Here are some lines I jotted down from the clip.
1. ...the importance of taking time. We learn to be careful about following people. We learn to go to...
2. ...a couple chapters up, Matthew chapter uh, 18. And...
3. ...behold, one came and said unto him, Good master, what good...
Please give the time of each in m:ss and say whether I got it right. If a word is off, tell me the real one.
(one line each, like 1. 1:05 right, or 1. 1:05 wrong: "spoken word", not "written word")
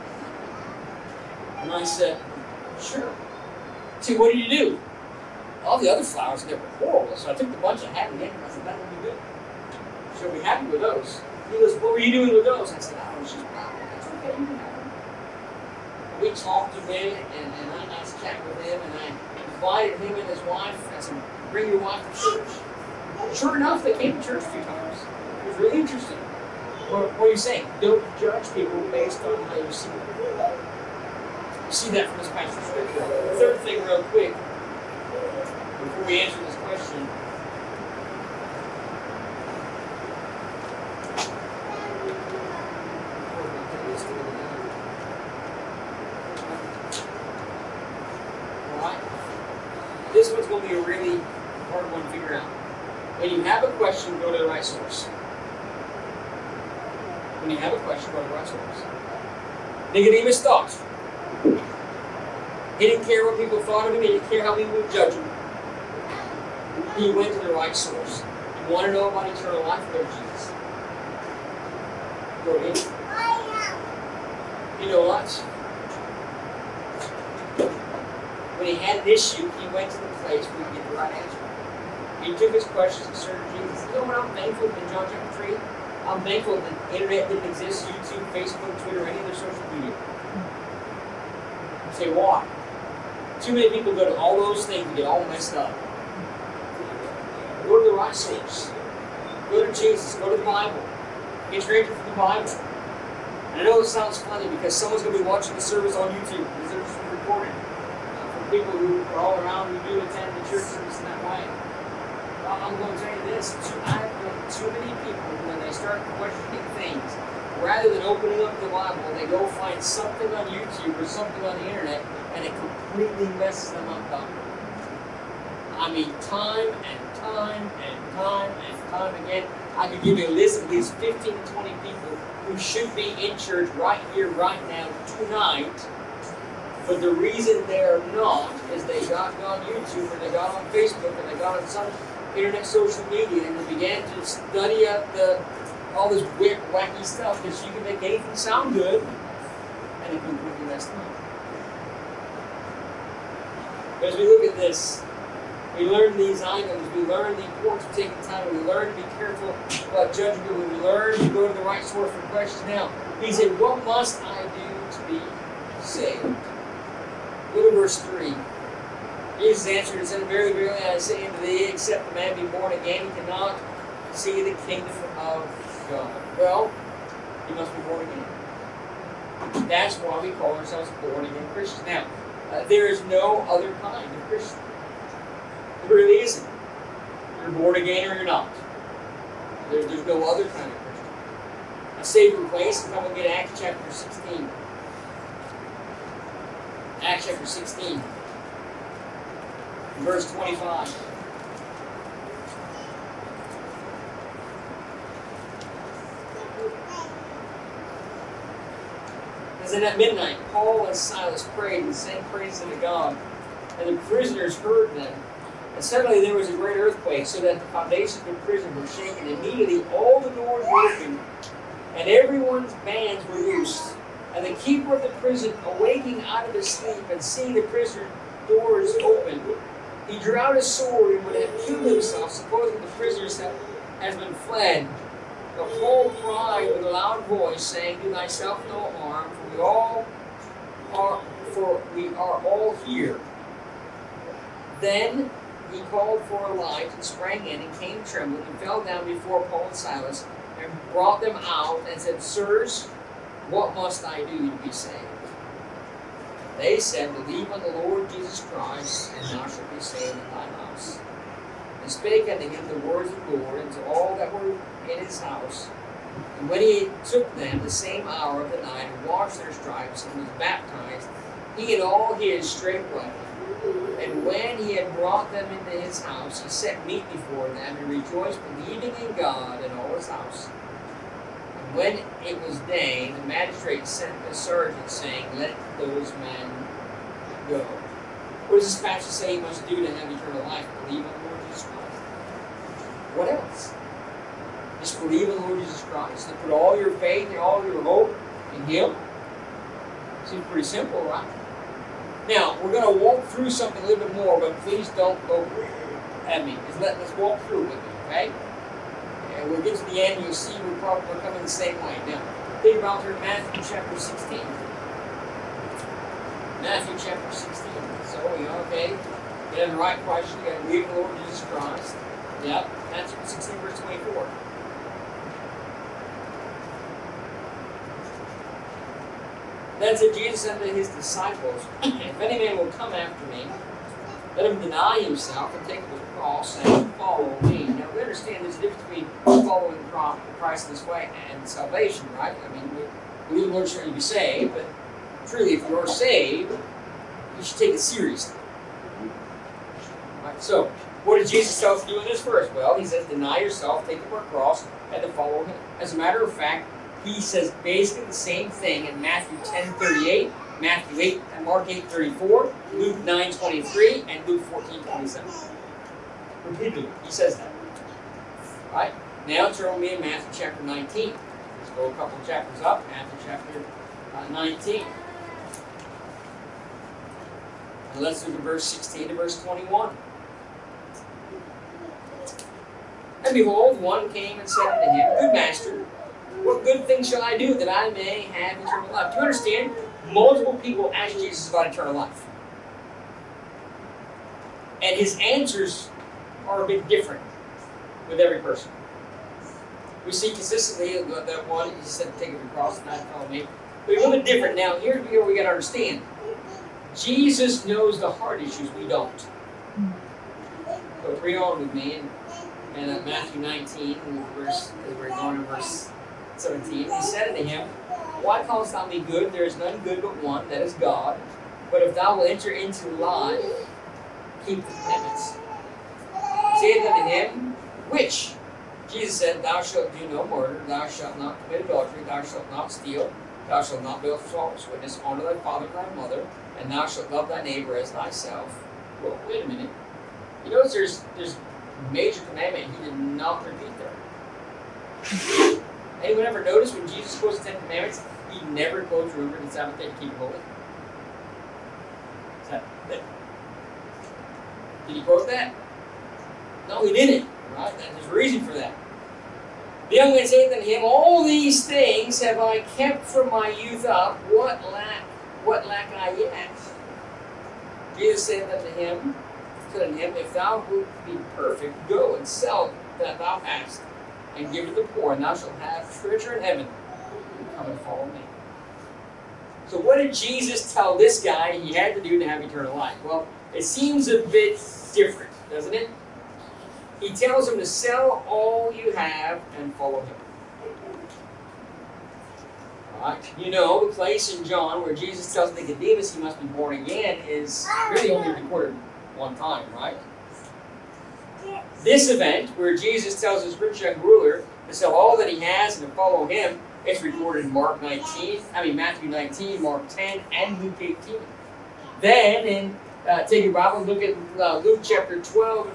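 1. 2:37 wrong: "judging", not "following"
2. 6:11 wrong: "19", not "18"
3. 6:23 right.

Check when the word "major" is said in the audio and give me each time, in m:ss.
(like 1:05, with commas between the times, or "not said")
7:21.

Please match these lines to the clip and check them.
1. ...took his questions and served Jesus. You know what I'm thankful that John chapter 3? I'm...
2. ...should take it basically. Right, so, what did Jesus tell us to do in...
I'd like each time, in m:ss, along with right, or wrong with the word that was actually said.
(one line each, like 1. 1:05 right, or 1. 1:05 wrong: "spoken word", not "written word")
1. 1:22 right
2. 5:47 wrong: "seriously", not "basically".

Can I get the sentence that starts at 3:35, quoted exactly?
And suddenly there was a great earthquake, so that the foundations of the prison were shaken.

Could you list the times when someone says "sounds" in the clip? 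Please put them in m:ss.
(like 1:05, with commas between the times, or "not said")
1:43, 2:28.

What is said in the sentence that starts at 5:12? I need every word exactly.
Now, think about through Matthew chapter 16.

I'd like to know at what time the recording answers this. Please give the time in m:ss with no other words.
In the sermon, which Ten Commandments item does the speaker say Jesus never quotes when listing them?
7:29.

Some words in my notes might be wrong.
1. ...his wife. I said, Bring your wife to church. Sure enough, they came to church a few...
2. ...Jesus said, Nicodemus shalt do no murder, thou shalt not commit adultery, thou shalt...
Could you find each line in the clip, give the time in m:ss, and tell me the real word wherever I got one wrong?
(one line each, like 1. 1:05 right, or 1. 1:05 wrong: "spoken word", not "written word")
1. 0:20 right
2. 7:08 wrong: "Thou", not "Nicodemus".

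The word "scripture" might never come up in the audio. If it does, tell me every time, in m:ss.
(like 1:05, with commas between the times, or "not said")
0:32, 4:48.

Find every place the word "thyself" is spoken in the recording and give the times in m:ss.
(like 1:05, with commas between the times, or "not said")
3:58, 7:17.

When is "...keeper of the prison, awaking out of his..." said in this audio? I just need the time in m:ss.
3:44.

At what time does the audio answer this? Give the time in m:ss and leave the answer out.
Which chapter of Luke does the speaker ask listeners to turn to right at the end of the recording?
8:34.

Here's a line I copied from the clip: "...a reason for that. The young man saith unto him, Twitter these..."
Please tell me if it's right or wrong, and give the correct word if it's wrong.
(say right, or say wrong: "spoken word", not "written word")
wrong: "All", not "Twitter".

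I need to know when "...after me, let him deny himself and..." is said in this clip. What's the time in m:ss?
5:32.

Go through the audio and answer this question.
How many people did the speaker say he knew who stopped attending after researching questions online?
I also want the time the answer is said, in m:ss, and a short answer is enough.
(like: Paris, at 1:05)
15, 20, at 2:10.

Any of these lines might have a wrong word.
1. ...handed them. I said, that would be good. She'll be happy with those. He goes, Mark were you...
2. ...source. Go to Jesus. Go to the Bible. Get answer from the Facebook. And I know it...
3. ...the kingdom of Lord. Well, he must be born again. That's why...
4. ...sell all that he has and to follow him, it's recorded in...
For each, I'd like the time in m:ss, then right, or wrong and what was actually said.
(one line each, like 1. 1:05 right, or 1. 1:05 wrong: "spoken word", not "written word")
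1. 0:08 wrong: "What", not "Mark"
2. 1:38 wrong: "Bible", not "Facebook"
3. 2:54 wrong: "God", not "Lord"
4. 8:24 right.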